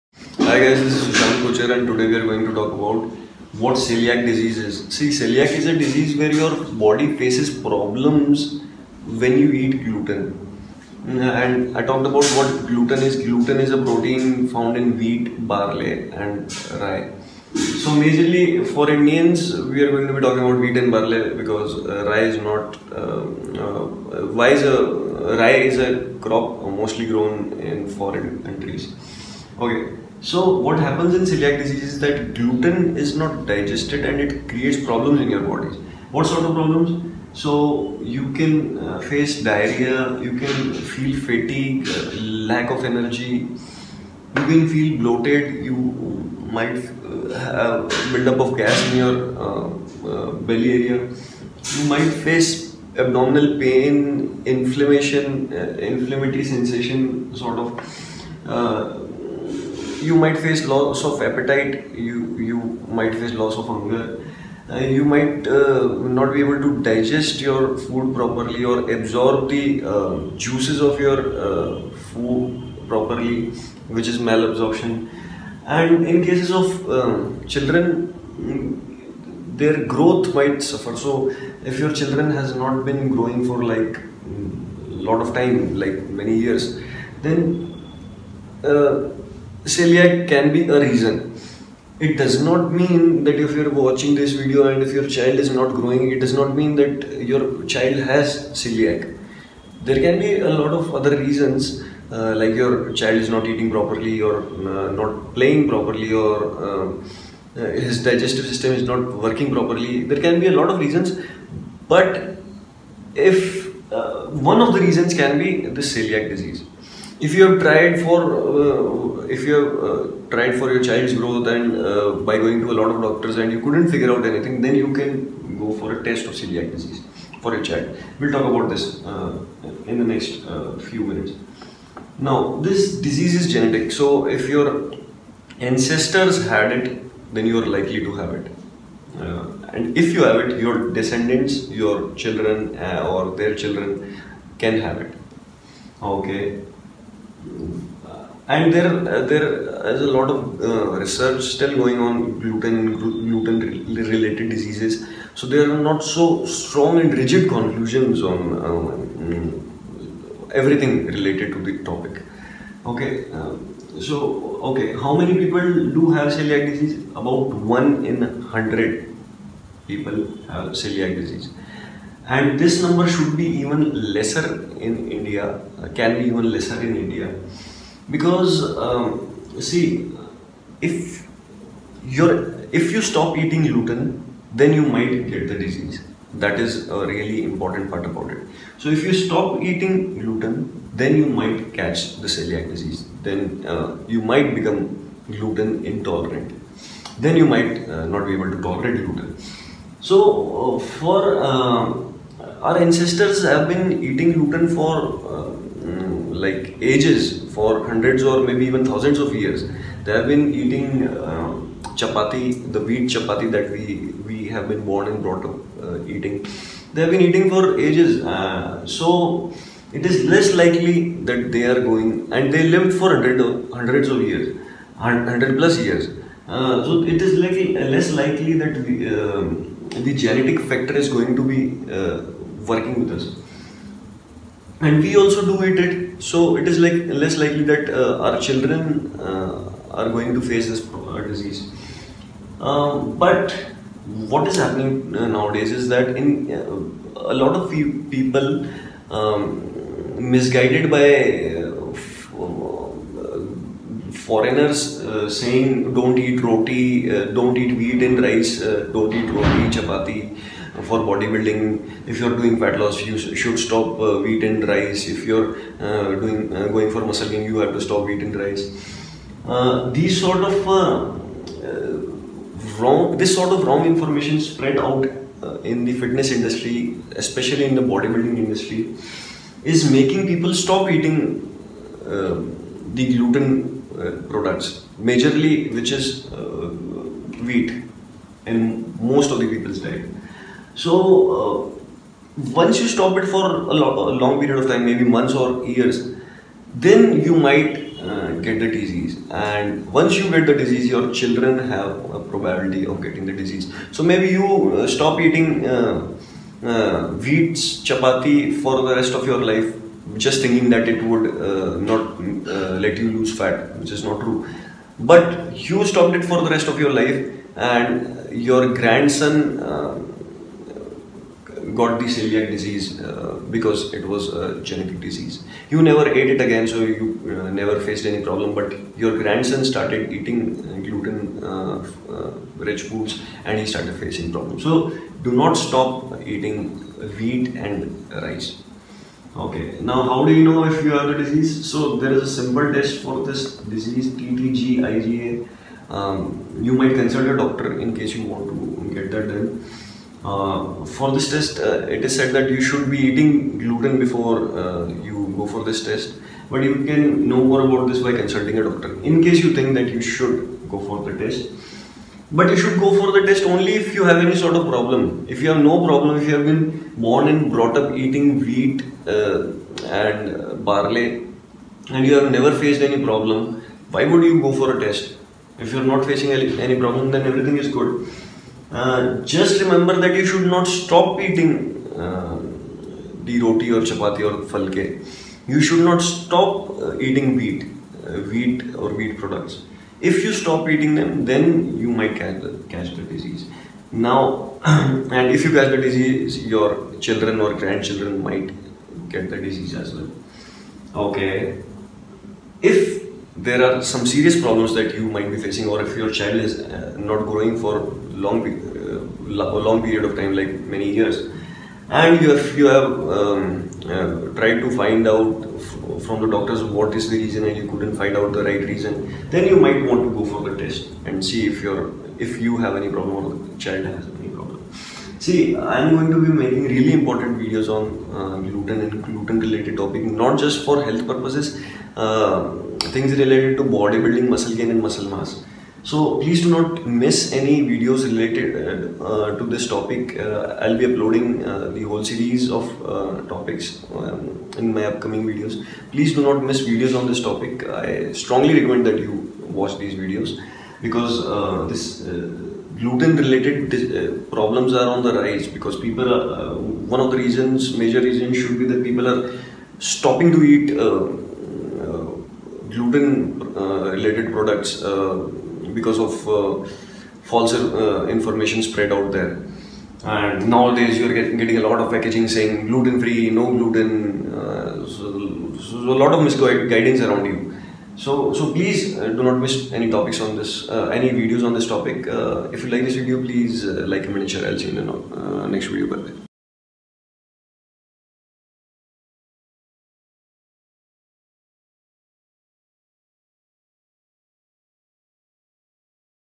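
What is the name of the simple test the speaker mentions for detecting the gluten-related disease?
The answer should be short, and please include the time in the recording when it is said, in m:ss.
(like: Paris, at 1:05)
TTG IgA, at 5:44.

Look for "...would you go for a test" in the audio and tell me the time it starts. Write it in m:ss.
6:14.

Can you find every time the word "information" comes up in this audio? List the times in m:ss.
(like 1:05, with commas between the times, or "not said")
4:33, 7:48.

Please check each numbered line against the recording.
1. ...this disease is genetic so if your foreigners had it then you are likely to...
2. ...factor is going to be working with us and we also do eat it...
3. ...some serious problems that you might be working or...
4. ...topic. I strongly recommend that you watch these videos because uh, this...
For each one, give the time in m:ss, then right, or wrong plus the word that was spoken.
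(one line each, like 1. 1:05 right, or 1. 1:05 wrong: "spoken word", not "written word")
1. 2:12 wrong: "ancestors", not "foreigners"
2. 3:50 right
3. 6:43 wrong: "facing", not "working"
4. 7:27 right.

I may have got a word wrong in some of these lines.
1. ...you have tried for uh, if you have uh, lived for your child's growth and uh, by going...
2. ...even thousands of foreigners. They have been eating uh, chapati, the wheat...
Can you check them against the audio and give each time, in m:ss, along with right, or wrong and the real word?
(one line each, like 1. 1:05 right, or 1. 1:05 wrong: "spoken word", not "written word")
1. 1:57 wrong: "tried", not "lived"
2. 3:28 wrong: "years", not "foreigners".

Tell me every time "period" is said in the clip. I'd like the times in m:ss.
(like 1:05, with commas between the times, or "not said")
4:54, 6:49.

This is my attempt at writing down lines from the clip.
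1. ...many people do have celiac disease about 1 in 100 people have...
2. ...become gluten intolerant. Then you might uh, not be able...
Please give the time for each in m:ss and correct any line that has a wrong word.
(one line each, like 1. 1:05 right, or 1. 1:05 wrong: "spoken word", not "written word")
1. 2:45 right
2. 3:14 right.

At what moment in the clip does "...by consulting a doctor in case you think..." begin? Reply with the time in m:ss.
5:58.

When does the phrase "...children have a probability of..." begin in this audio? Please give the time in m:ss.
5:01.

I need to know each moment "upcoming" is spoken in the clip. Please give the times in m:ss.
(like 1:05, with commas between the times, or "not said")
7:24.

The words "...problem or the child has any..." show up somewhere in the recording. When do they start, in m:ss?
7:02.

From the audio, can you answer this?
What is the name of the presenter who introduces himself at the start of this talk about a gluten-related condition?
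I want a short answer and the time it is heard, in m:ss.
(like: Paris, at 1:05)
Sushant Kochar, at 0:01.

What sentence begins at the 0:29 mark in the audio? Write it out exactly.
Okay, so what happens in celiac disease is that gluten is not digested and it creates problems in your body.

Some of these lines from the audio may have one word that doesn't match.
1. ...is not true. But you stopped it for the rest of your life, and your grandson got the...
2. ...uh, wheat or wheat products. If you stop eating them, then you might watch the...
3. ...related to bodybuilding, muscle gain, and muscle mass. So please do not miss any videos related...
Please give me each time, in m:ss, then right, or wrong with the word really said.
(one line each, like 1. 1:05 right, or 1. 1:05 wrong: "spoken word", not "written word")
1. 5:13 right
2. 6:28 wrong: "catch", not "watch"
3. 7:13 right.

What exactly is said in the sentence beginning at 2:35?
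So there are not so strong and rigid conclusions on um, everything related to the topic.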